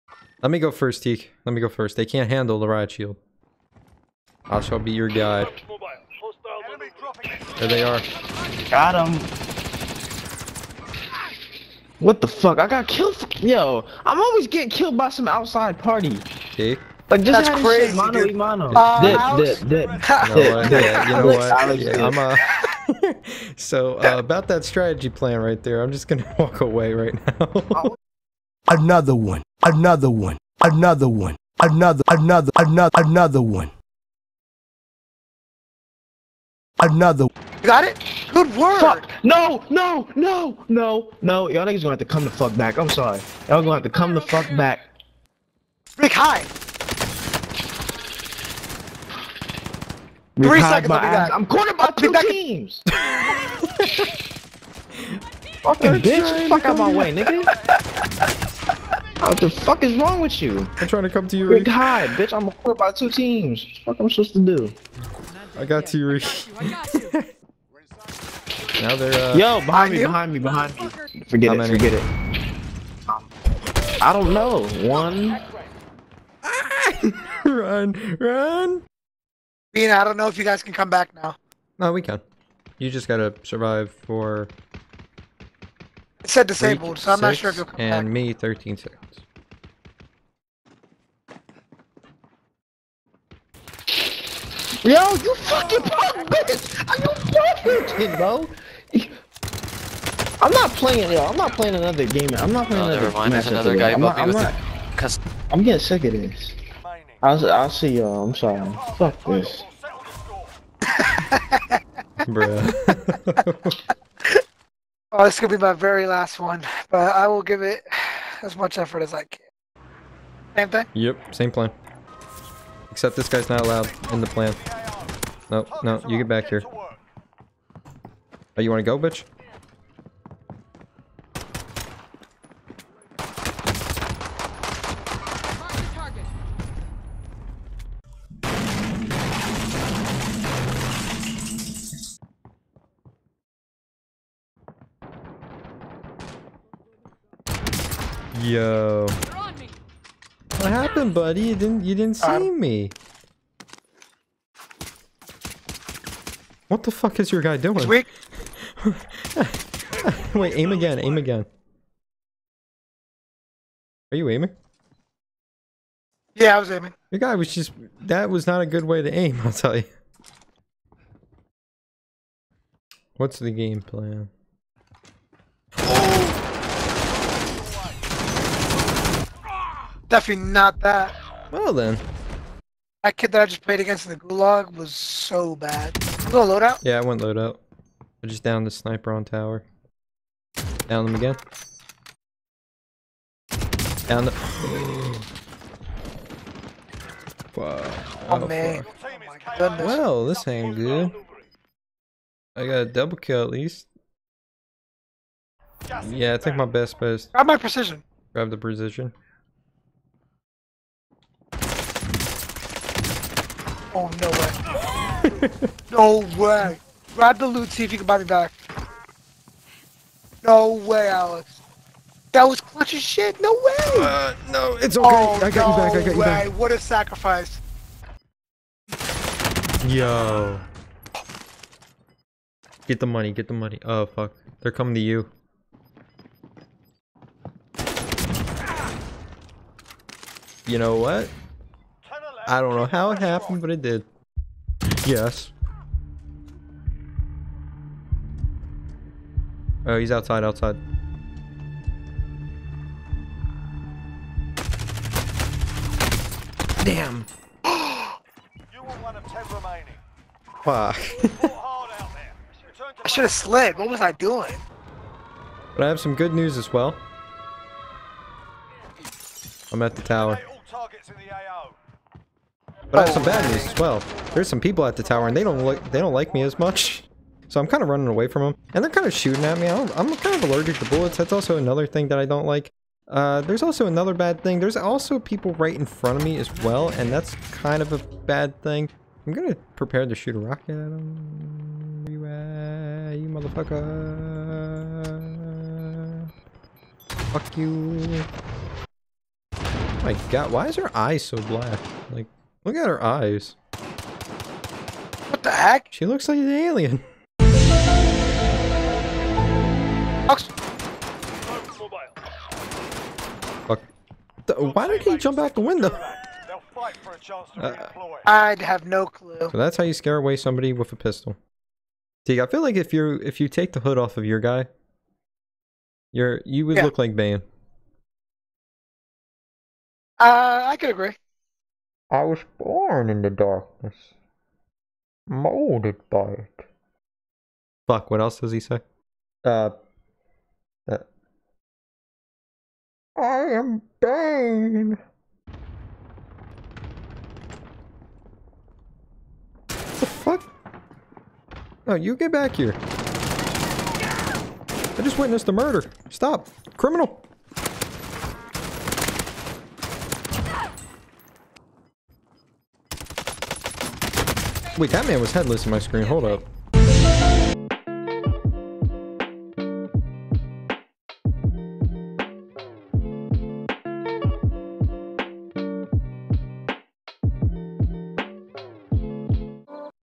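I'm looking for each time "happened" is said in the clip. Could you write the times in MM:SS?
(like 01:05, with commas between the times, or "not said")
02:30, 04:03.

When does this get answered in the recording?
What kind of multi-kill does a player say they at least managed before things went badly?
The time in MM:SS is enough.
03:22.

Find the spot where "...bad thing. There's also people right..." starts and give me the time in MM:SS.
04:44.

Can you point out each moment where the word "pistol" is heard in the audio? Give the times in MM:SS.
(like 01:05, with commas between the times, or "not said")
05:20.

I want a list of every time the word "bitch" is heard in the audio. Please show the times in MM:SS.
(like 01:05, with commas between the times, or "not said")
00:56, 01:02, 01:36, 02:08.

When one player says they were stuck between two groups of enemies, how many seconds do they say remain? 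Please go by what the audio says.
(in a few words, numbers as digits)
3.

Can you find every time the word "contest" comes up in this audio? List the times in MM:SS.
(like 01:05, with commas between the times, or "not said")
not said.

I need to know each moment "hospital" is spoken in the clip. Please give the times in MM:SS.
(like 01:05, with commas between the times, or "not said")
not said.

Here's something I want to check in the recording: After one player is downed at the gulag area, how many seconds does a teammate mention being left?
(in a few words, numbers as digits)
13.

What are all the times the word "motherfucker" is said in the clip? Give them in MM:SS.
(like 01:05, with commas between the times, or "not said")
04:53.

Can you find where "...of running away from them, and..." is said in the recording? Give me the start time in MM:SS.
04:37.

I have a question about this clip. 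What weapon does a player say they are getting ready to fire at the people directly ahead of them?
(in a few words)
A rocket.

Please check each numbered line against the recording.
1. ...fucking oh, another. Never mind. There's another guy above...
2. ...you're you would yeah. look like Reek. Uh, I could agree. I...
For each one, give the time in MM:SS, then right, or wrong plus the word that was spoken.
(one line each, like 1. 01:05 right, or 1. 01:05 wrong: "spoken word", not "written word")
1. 01:42 wrong: "playing", not "fucking"
2. 05:26 wrong: "Bane", not "Reek".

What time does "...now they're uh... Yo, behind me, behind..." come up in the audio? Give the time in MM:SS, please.
01:08.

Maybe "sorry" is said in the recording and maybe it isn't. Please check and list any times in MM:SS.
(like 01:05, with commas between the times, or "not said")
00:42, 01:48.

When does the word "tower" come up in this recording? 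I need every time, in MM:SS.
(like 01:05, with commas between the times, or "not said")
03:09, 04:30, 04:35.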